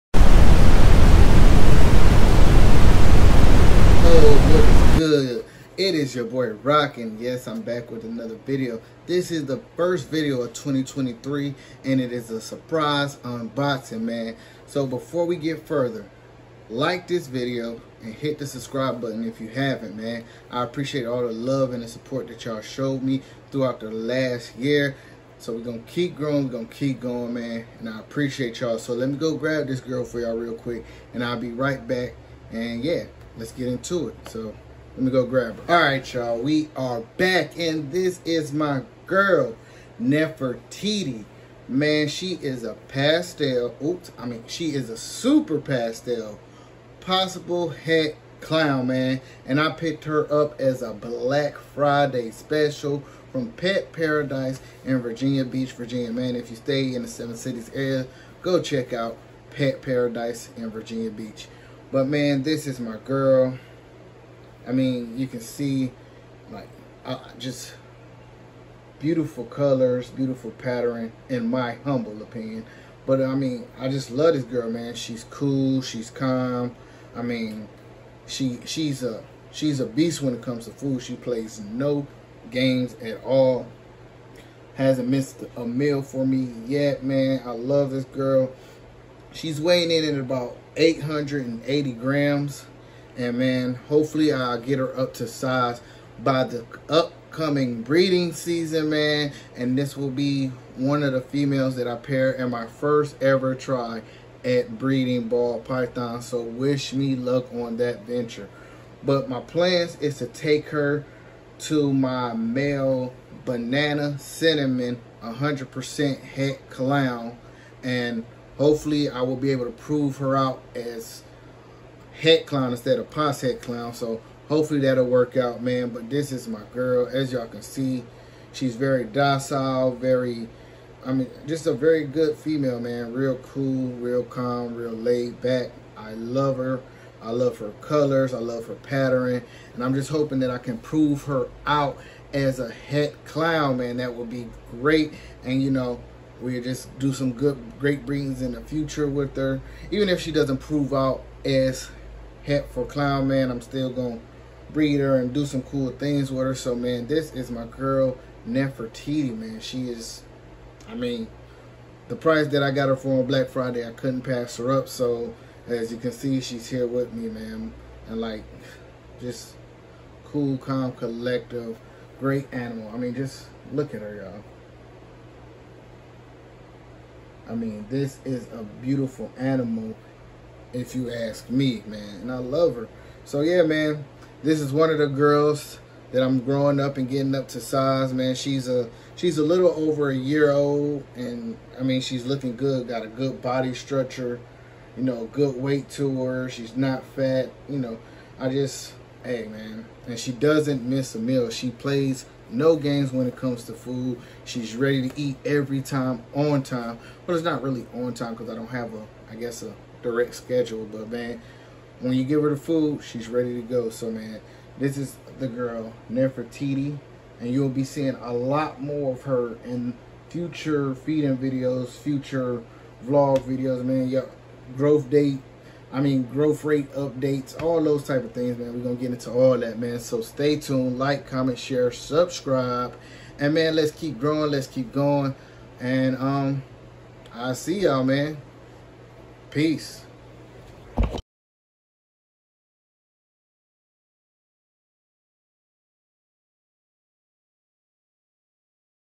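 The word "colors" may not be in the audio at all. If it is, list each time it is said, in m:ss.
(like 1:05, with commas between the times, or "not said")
1:09, 2:17.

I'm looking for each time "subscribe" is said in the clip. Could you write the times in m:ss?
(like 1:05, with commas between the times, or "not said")
0:18, 3:51.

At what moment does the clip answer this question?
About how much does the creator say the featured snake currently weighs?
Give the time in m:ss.
1:30.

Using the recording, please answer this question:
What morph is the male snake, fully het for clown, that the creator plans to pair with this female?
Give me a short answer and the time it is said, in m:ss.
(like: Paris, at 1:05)
banana cinnamon, at 1:53.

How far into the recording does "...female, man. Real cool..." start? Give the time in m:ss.
2:12.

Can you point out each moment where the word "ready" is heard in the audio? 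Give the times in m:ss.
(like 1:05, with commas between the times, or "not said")
3:24, 3:33.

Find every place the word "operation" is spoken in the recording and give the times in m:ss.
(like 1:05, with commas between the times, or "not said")
not said.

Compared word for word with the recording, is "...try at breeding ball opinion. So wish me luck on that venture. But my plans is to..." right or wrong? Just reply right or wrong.
wrong.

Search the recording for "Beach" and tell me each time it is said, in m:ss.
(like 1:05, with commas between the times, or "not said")
0:55, 1:01.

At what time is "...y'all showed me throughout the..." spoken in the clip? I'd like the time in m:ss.
0:22.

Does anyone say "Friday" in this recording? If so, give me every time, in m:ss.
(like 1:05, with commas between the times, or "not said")
0:51, 2:43.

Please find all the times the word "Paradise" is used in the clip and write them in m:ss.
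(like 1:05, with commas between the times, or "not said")
0:53, 0:59.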